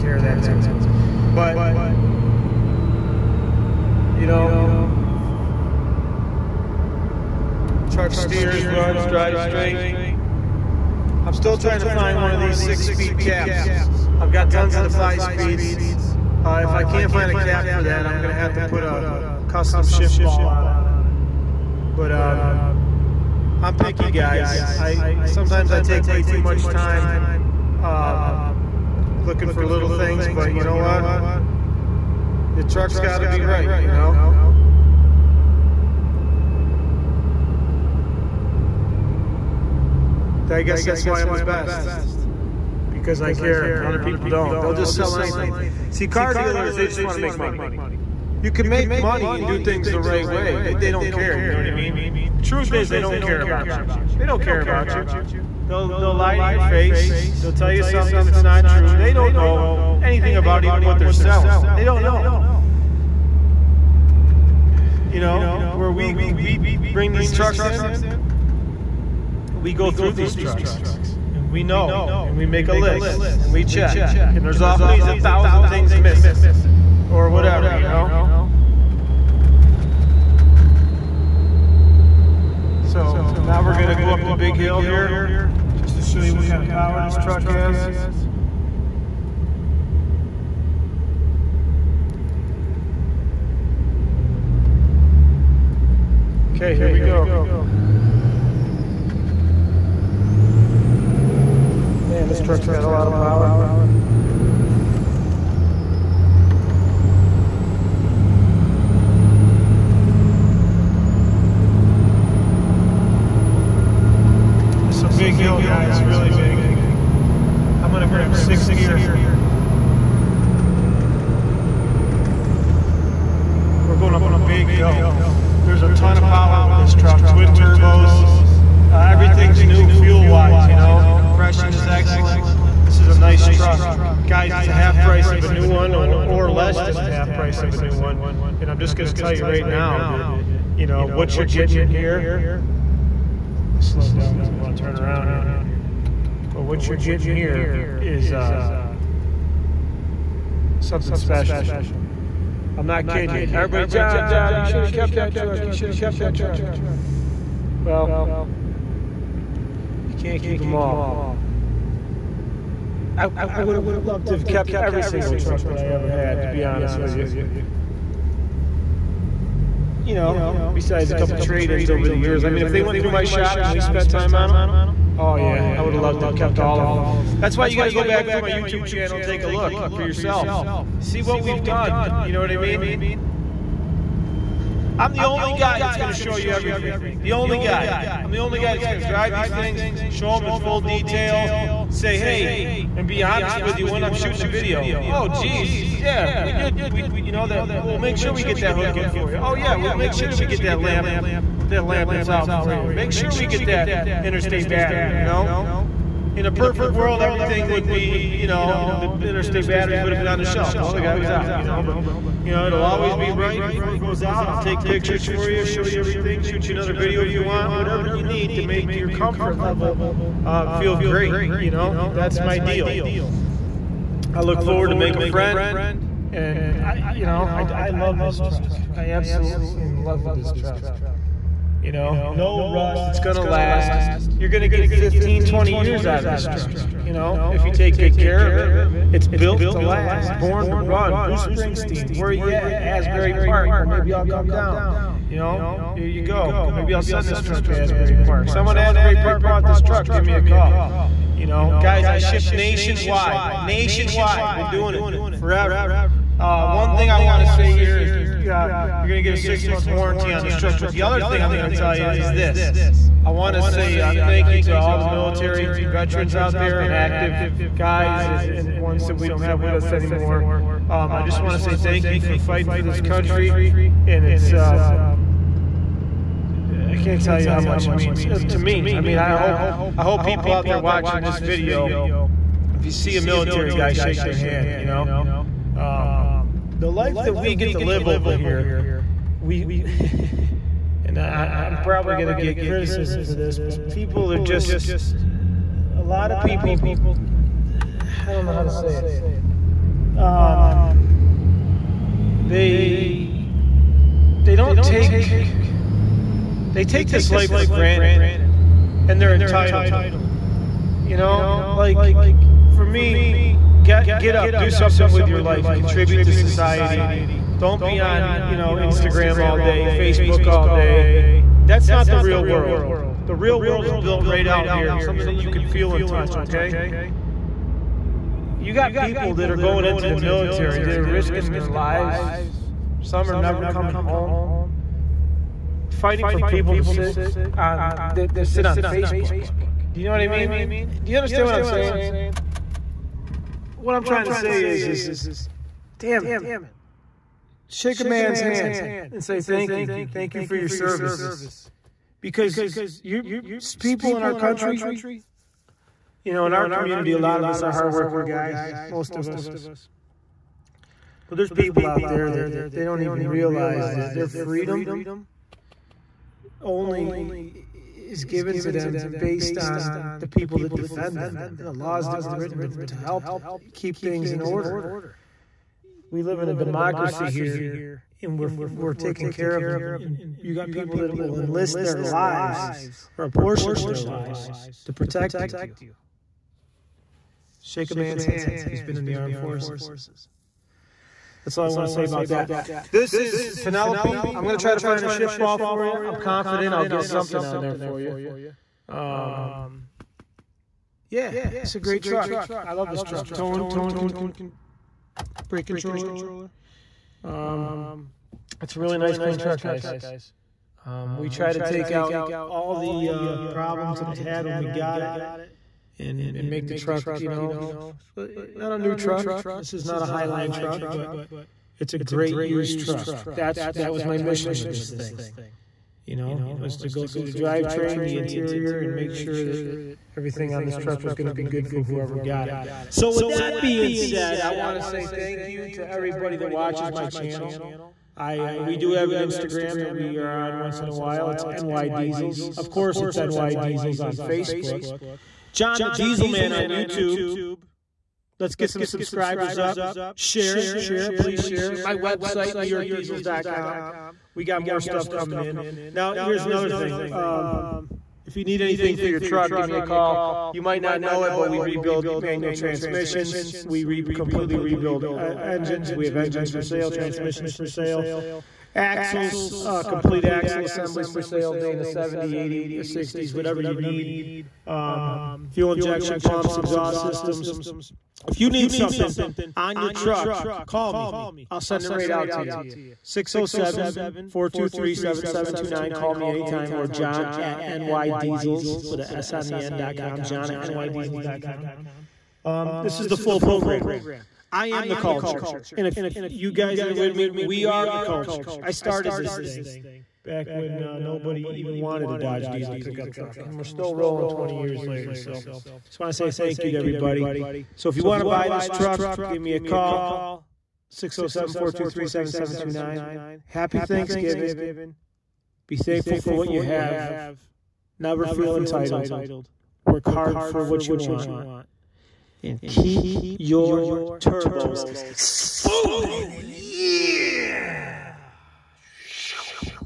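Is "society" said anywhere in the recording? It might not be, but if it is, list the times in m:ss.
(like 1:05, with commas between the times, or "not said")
5:16.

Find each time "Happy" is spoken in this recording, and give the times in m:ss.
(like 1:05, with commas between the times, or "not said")
8:33.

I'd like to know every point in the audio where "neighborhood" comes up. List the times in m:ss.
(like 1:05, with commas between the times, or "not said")
not said.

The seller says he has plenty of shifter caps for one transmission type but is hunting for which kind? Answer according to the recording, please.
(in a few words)
six-speed.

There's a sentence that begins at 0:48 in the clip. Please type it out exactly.
You can make money and do things the right way.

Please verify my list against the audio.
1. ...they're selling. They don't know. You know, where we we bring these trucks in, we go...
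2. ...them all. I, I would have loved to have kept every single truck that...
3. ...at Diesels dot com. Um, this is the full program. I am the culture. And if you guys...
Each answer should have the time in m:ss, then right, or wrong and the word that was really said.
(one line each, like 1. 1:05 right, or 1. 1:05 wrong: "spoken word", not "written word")
1. 1:00 right
2. 2:40 right
3. 8:10 wrong: "NYDiesels", not "Diesels".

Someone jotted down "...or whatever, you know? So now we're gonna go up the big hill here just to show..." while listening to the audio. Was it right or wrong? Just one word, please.
right.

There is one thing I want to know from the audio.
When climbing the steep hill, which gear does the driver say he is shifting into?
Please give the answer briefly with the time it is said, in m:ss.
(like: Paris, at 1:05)
sixth gear, at 1:58.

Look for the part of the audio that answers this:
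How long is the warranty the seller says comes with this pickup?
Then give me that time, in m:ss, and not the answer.
4:19.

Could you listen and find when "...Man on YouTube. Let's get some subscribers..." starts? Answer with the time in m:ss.
7:26.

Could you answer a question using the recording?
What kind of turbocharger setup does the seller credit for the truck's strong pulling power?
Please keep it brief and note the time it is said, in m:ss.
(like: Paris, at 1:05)
twin turbos, at 2:07.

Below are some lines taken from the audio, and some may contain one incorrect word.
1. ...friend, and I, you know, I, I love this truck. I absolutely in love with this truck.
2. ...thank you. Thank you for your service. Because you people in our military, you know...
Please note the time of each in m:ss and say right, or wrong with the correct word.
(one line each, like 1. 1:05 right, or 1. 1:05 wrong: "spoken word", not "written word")
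1. 3:45 right
2. 5:49 wrong: "country", not "military".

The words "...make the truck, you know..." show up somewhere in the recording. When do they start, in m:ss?
6:56.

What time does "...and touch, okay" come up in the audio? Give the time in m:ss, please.
5:25.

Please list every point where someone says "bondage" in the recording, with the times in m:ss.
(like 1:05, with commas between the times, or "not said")
not said.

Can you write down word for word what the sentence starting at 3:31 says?
You know, but you know, it'll always be right before it goes out.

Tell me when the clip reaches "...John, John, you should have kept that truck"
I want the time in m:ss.
2:33.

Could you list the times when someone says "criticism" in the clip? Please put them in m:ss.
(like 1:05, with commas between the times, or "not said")
4:52.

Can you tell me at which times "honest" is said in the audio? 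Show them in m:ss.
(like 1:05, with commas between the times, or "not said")
2:46, 3:13.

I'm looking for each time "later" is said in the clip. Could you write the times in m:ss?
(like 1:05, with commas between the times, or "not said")
8:24.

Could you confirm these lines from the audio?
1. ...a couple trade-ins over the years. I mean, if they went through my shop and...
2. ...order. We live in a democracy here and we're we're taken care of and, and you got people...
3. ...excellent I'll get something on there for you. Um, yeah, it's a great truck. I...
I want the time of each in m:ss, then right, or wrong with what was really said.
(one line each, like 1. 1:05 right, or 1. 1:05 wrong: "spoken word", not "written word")
1. 2:51 right
2. 6:14 right
3. 6:36 wrong: "confident", not "excellent".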